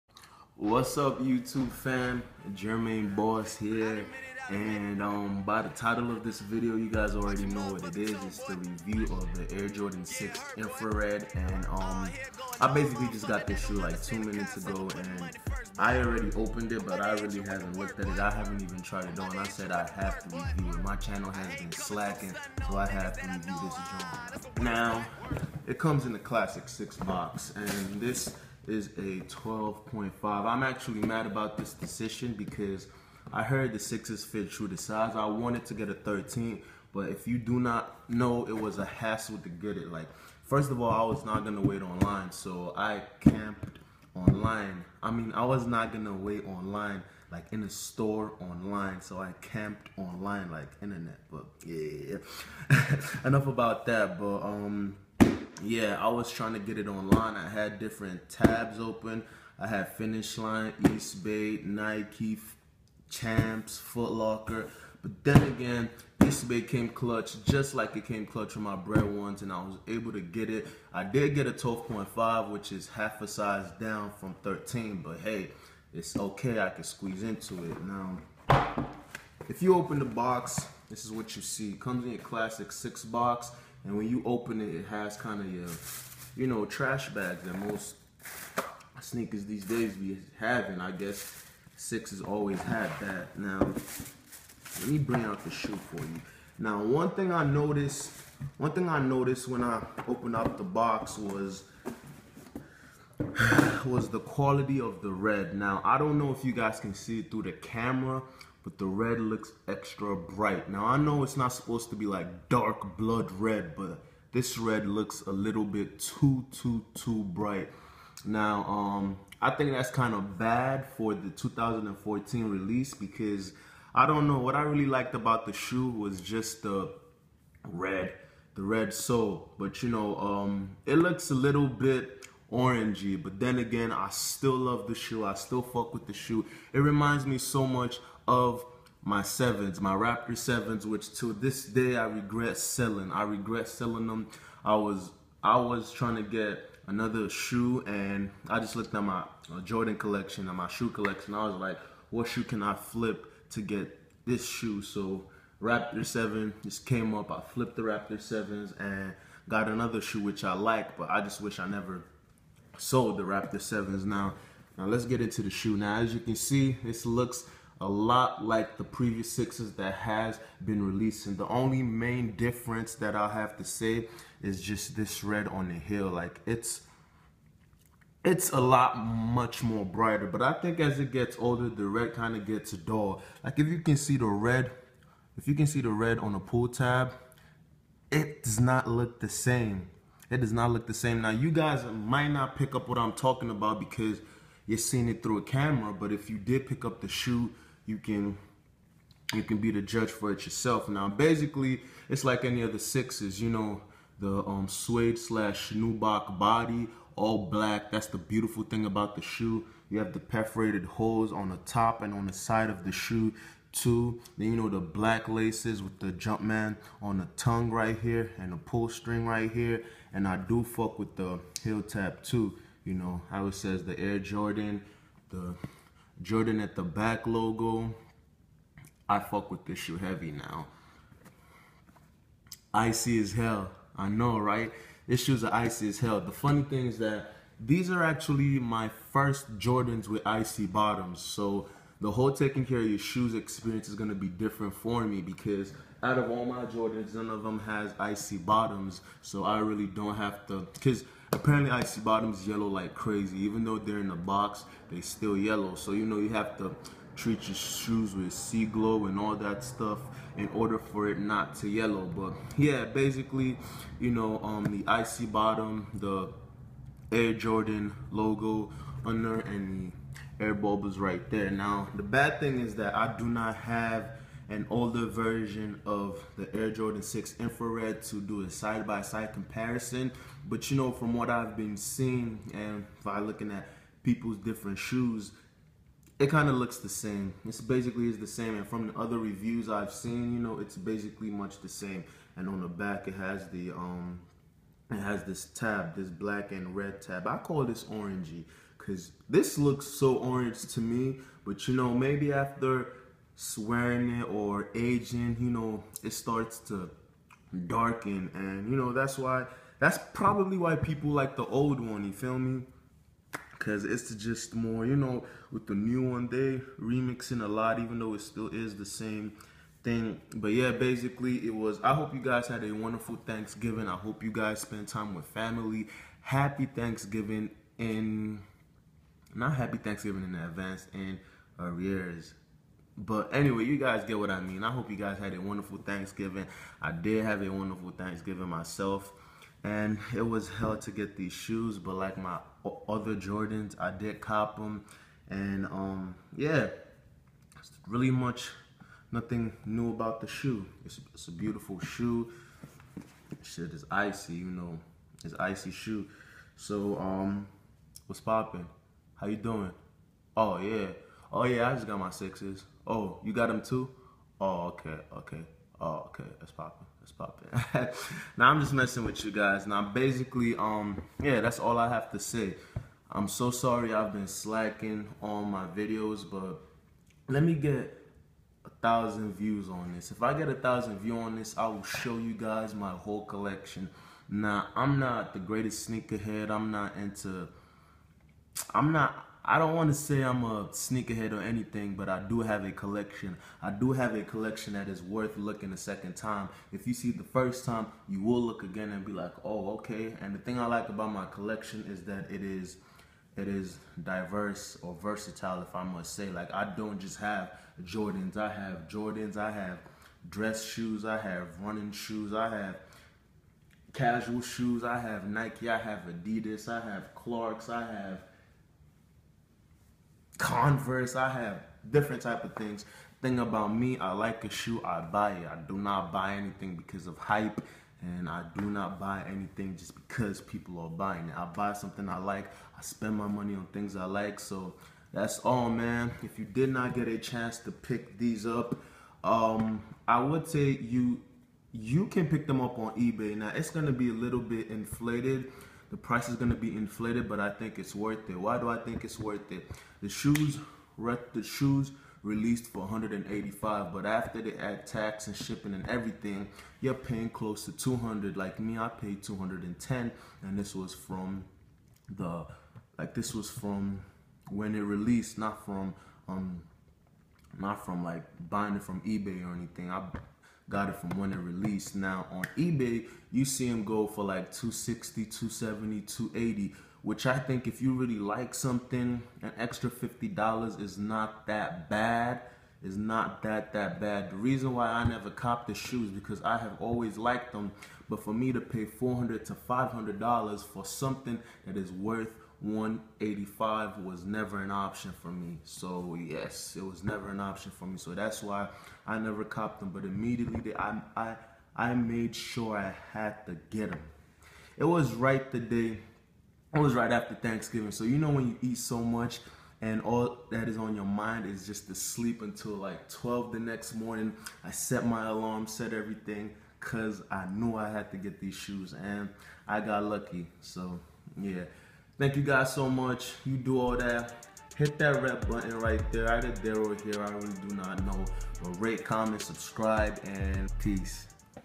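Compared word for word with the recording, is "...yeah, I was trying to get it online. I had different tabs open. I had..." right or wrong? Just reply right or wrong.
right.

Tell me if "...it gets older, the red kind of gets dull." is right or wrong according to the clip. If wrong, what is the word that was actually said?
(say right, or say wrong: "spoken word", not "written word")
right.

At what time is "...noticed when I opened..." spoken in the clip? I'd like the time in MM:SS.
01:38.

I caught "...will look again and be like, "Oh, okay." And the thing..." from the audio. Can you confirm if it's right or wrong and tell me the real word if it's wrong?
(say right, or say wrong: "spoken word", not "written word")
right.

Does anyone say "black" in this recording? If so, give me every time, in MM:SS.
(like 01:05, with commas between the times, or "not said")
03:27, 03:34, 04:56.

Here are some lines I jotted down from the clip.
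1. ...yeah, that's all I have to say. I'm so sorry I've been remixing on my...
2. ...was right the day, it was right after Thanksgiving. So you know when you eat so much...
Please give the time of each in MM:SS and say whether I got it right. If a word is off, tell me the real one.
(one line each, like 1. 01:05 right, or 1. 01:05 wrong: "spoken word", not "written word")
1. 06:11 wrong: "slacking", not "remixing"
2. 08:24 right.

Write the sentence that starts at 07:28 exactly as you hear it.
Why do I think it's worth it?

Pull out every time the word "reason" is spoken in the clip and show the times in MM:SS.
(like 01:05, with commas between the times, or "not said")
08:04.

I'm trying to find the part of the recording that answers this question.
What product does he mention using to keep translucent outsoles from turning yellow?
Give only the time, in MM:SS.
04:18.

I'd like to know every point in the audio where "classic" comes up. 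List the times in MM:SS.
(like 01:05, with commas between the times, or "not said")
00:26, 01:22.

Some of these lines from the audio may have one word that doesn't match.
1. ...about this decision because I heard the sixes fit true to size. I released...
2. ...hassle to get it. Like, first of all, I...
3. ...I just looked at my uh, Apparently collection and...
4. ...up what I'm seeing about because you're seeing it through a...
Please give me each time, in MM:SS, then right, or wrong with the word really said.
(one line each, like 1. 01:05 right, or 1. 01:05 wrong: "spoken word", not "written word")
1. 00:31 wrong: "wanted", not "released"
2. 00:38 right
3. 02:28 wrong: "Jordan", not "Apparently"
4. 03:12 wrong: "talking", not "seeing".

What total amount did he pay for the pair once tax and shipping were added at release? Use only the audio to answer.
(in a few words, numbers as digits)
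$210.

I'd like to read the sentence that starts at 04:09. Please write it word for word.
So I really don't have to, because Apparently, icy bottoms yellow like crazy.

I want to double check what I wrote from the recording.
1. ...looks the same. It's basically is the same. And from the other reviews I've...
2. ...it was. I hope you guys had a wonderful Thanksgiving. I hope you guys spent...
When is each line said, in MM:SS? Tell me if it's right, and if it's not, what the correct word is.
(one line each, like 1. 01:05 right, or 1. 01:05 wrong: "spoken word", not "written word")
1. 04:46 right
2. 05:21 right.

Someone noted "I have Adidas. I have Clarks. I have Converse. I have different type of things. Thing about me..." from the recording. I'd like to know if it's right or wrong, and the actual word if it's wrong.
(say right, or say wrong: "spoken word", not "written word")
right.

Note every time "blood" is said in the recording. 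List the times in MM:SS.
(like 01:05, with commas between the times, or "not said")
01:52.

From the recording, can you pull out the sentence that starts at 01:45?
Now, I don't know if you guys can see it through the camera, but the red looks extra bright.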